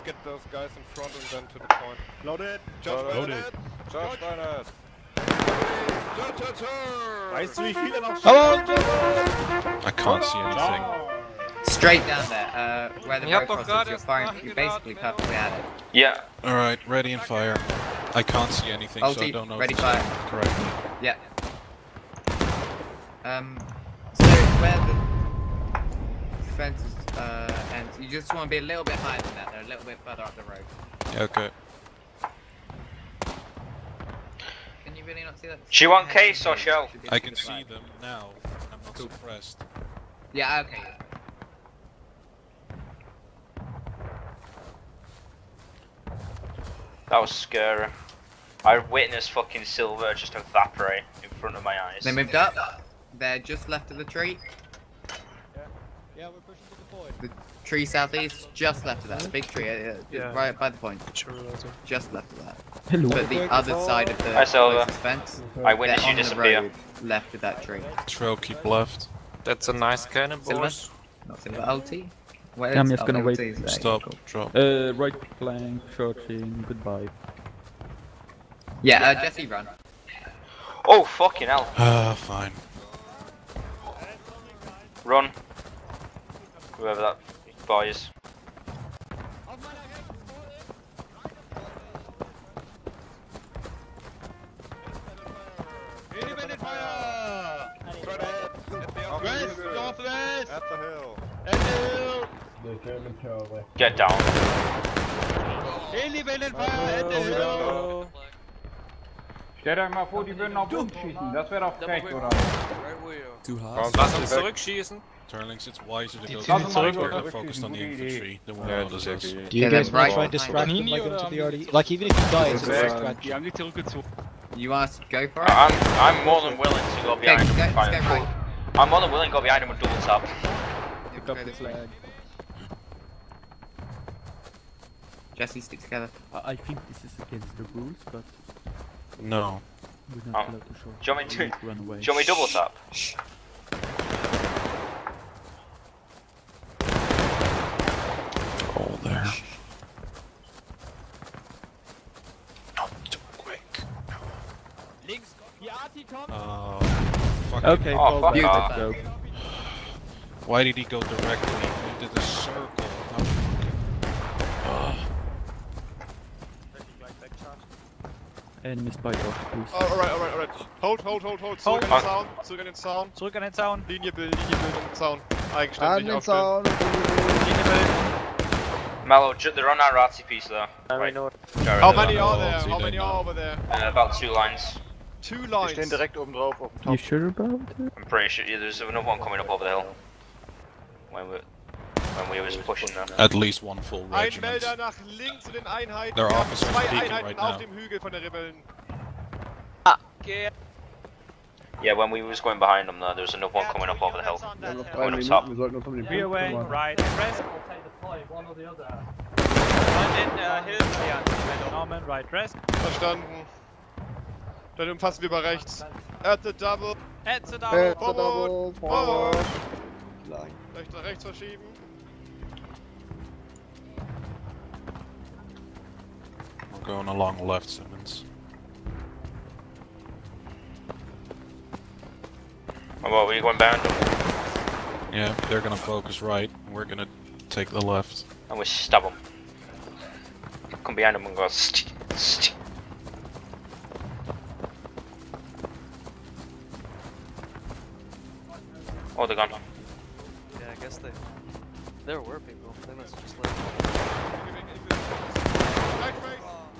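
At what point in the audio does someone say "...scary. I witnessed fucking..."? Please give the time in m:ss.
0:47.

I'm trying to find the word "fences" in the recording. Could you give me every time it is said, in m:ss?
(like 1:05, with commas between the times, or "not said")
0:26, 1:04.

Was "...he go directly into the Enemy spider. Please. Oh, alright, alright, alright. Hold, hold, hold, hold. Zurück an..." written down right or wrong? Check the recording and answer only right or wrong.
right.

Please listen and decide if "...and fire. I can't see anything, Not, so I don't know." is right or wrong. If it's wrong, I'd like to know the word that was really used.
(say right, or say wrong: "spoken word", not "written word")
wrong: "Ulti", not "Not".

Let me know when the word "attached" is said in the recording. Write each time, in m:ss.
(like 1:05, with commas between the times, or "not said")
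not said.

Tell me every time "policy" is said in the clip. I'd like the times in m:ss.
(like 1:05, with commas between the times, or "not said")
not said.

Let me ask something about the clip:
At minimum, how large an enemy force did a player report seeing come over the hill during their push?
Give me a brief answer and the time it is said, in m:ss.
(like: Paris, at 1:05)
1 full regiment, at 3:13.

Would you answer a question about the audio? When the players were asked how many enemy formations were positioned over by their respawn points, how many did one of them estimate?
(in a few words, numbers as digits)
2 lines.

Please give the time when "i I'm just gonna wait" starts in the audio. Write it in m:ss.
1:12.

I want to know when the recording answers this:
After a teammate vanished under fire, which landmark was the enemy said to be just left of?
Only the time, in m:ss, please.
0:59.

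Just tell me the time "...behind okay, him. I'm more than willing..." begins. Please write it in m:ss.
2:07.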